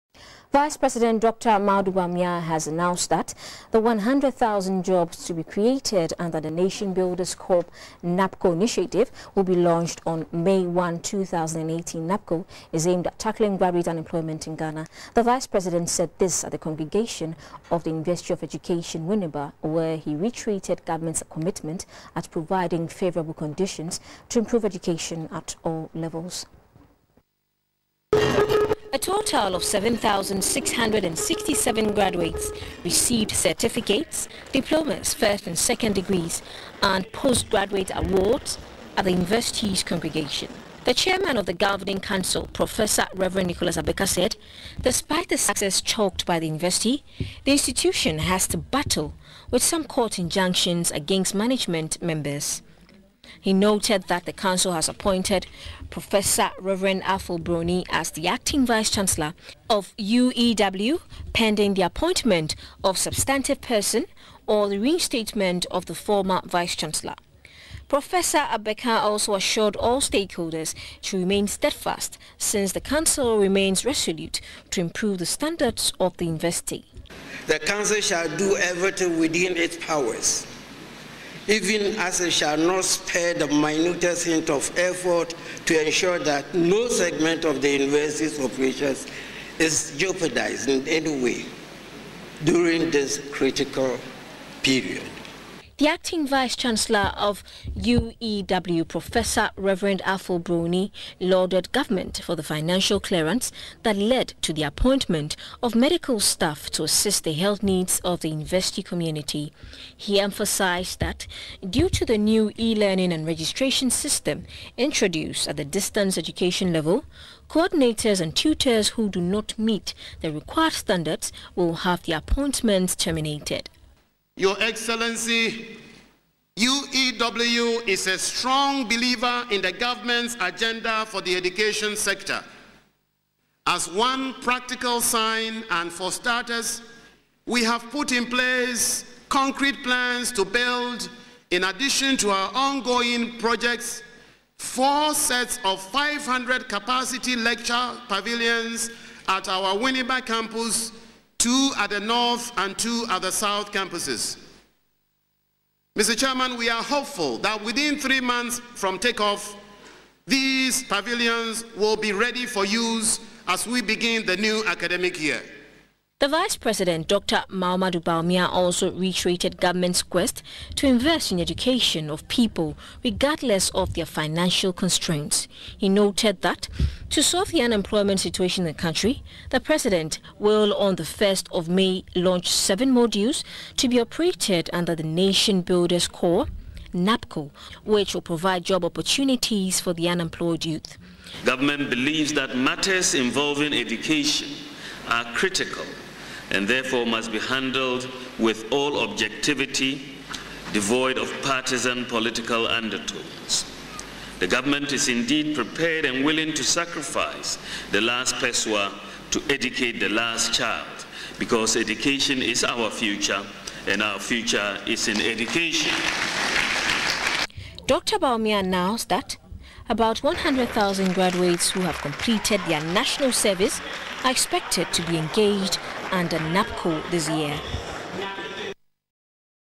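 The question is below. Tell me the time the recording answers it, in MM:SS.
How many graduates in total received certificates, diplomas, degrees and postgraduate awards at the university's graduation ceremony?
00:29.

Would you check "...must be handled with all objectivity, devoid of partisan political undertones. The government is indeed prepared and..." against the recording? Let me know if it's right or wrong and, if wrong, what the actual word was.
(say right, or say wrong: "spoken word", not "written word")
right.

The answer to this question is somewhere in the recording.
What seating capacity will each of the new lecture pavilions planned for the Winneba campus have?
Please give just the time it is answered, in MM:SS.
02:25.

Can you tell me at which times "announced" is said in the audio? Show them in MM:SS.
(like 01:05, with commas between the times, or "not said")
00:02, 03:38.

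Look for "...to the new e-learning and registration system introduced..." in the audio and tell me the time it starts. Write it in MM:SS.
01:51.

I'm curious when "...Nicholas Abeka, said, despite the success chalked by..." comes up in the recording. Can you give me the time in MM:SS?
00:43.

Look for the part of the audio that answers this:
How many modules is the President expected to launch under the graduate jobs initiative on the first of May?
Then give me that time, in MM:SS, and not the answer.
03:02.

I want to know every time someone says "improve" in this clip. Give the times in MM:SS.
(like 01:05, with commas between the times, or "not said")
00:24, 01:14.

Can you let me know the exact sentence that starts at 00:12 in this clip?
NABCO is aimed at tackling graduate unemployment in Ghana.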